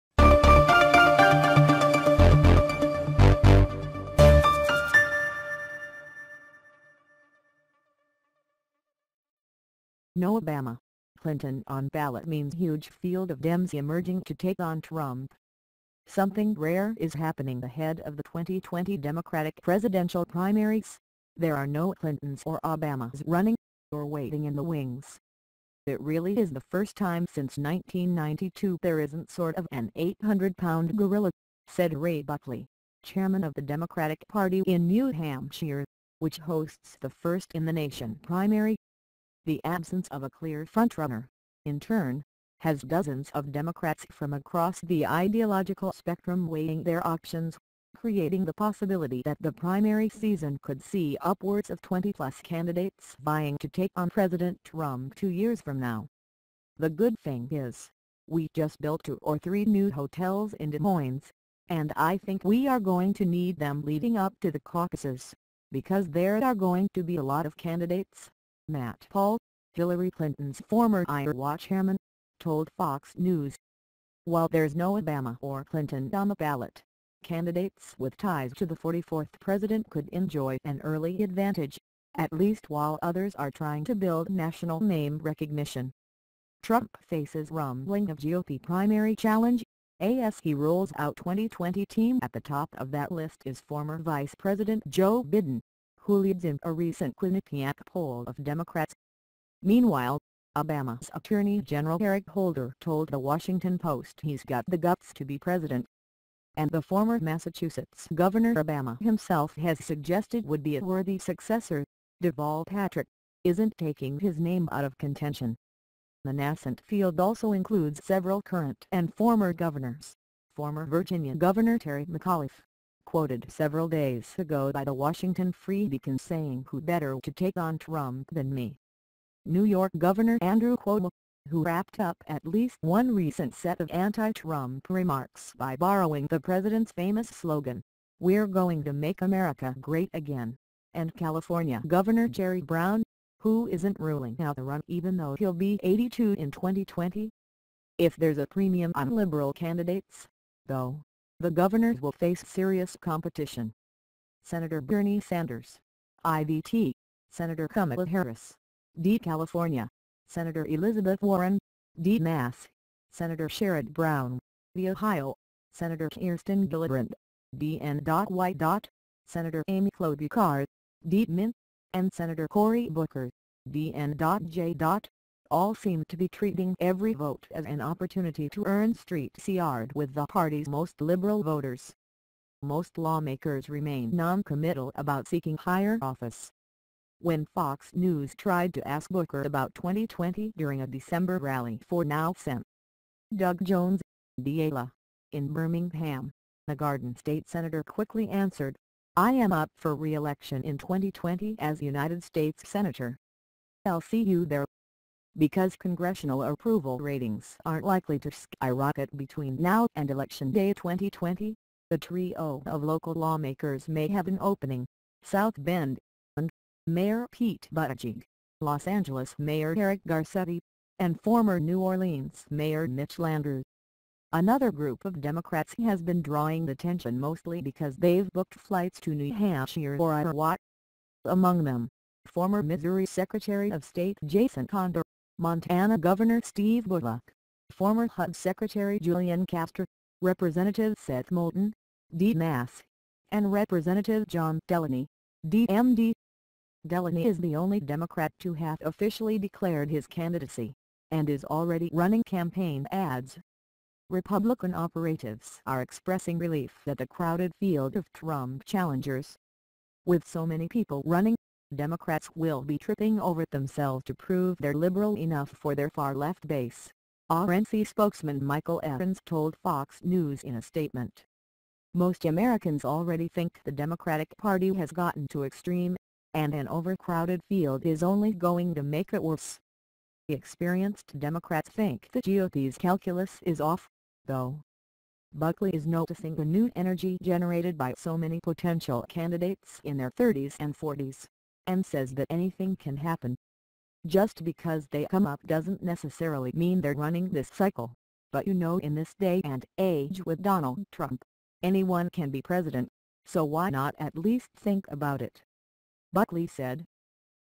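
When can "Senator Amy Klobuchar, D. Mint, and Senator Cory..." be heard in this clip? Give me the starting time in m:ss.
2:49.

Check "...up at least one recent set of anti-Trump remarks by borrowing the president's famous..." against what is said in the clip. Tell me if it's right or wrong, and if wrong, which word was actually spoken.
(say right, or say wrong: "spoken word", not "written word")
right.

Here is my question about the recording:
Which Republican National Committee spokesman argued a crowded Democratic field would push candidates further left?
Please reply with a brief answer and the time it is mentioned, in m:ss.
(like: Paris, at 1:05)
Michael Evans, at 4:28.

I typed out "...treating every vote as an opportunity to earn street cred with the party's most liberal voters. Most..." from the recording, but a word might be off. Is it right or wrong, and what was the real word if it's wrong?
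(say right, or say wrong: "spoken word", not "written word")
right.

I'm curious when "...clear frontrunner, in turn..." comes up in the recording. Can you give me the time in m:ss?
0:40.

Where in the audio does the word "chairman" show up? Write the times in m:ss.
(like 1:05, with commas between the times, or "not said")
0:33, 1:11.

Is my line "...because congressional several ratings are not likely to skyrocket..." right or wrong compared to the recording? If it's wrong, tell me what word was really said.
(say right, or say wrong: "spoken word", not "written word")
wrong: "approval", not "several".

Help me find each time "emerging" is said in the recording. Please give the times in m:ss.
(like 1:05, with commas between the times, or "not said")
0:13.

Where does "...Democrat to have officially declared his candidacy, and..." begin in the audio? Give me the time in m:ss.
4:07.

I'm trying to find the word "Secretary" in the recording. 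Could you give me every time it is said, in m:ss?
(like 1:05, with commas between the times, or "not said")
3:53, 3:58.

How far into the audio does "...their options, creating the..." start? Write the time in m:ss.
0:46.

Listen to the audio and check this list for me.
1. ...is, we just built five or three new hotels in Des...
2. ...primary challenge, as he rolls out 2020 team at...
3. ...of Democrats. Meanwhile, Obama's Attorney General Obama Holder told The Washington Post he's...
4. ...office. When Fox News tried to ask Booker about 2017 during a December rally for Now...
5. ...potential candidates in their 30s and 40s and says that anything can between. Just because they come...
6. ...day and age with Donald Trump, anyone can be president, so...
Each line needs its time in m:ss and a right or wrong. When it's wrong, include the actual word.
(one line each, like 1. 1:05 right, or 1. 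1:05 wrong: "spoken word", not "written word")
1. 0:57 wrong: "two", not "five"
2. 1:28 right
3. 1:38 wrong: "Eric", not "Obama"
4. 3:06 wrong: "2020", not "2017"
5. 4:48 wrong: "happen", not "between"
6. 4:59 right.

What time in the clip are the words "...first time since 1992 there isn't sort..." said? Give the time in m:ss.
0:26.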